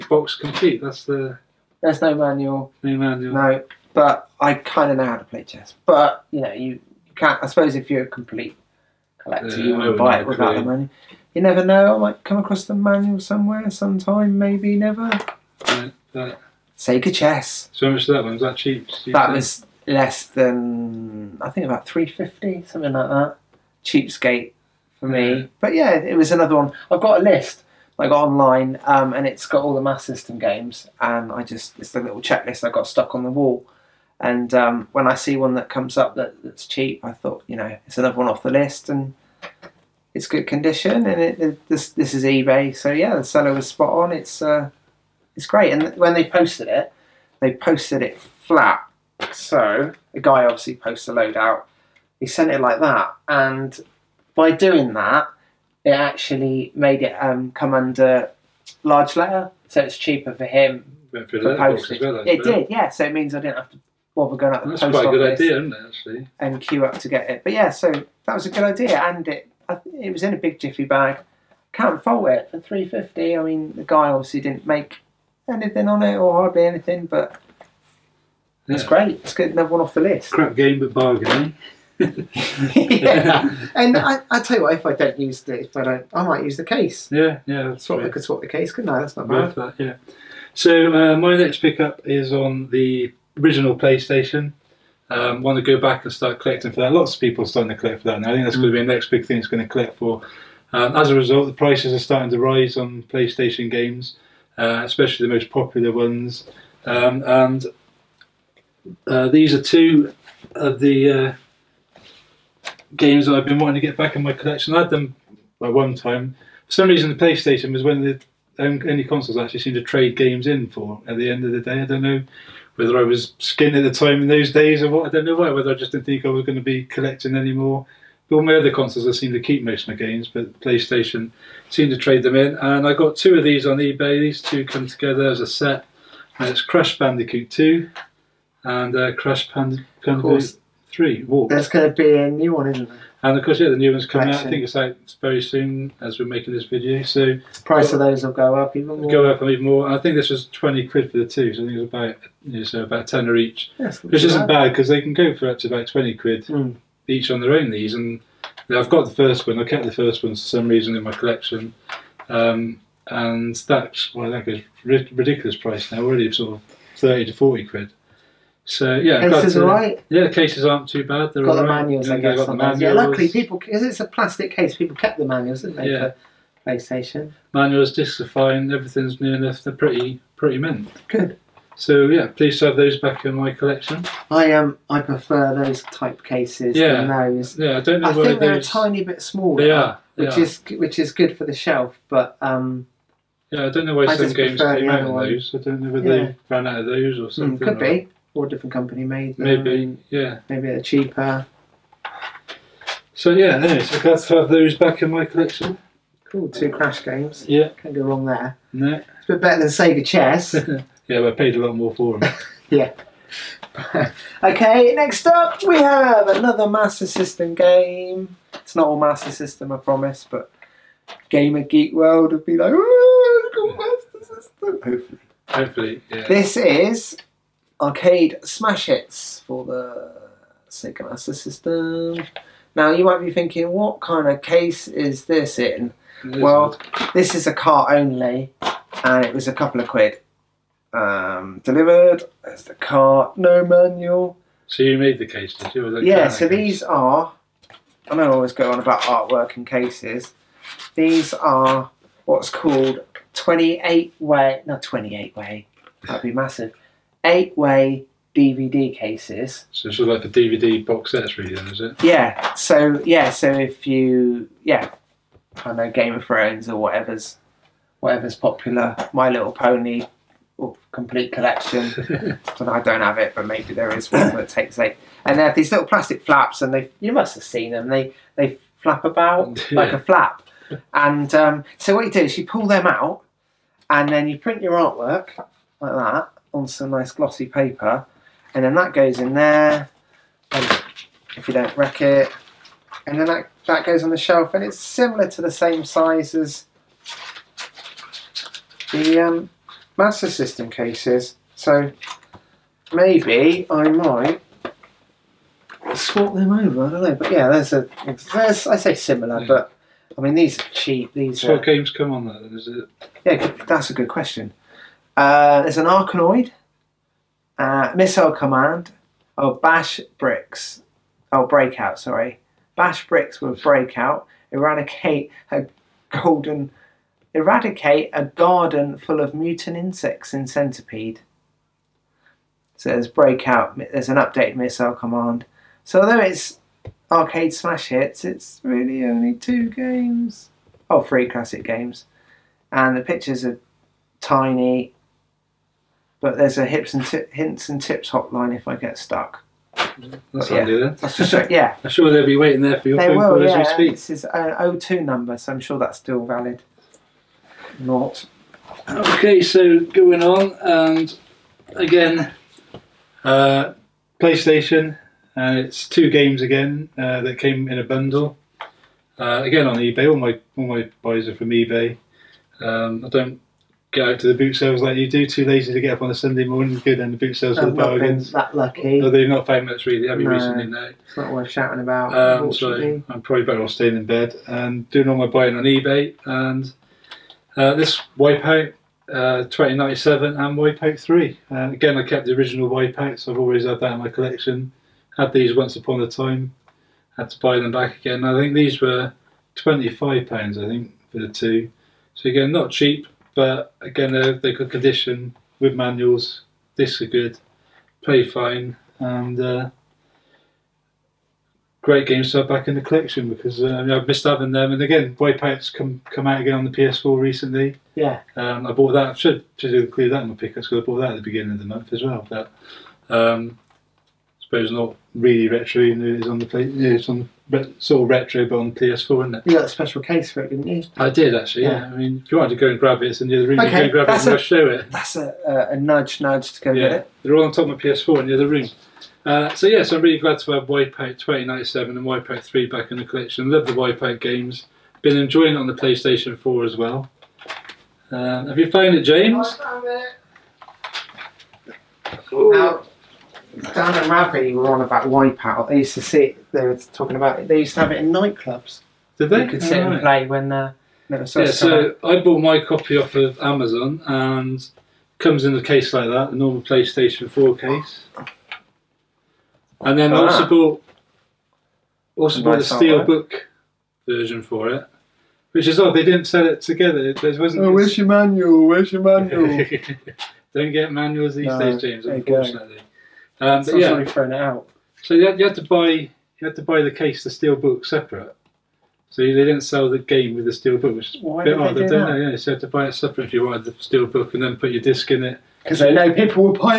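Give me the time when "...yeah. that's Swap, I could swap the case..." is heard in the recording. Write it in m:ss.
1:27.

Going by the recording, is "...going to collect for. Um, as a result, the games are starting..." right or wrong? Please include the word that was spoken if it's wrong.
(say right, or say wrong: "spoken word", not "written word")
wrong: "prices", not "games".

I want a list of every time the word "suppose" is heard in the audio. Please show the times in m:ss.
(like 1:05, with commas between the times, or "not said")
0:07, 7:04.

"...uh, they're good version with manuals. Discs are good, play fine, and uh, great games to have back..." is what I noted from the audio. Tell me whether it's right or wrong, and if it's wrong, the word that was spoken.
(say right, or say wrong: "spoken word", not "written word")
wrong: "condition", not "version".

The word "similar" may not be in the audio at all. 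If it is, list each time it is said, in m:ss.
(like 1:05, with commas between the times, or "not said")
4:54, 5:08.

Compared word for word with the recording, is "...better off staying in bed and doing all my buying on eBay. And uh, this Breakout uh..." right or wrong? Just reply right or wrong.
wrong.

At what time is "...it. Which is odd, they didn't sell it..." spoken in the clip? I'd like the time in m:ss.
7:54.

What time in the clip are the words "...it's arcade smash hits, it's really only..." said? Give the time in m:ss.
5:36.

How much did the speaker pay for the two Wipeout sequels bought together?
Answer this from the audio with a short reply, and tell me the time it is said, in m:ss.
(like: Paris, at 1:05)
£25, at 6:39.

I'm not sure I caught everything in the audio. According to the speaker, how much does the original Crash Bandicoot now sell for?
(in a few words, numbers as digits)
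£30 to £40.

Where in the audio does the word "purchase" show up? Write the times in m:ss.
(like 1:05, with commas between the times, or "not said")
not said.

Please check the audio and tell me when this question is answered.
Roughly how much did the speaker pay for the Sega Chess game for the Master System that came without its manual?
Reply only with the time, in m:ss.
0:21.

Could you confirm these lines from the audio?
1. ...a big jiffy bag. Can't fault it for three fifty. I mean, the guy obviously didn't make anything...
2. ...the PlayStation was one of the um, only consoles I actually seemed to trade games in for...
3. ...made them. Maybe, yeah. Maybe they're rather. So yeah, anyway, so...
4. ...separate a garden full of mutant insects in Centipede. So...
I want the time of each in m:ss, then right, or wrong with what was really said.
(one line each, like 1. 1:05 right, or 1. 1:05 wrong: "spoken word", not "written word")
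1. 1:10 right
2. 1:57 right
3. 3:19 wrong: "cheaper", not "rather"
4. 5:27 wrong: "eradicate", not "separate".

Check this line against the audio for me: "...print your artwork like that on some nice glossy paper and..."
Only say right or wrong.
right.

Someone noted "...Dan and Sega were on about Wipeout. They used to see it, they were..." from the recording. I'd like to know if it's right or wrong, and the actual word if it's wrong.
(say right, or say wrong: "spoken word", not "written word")
wrong: "Ravi", not "Sega".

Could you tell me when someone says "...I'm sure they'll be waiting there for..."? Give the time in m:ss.
5:51.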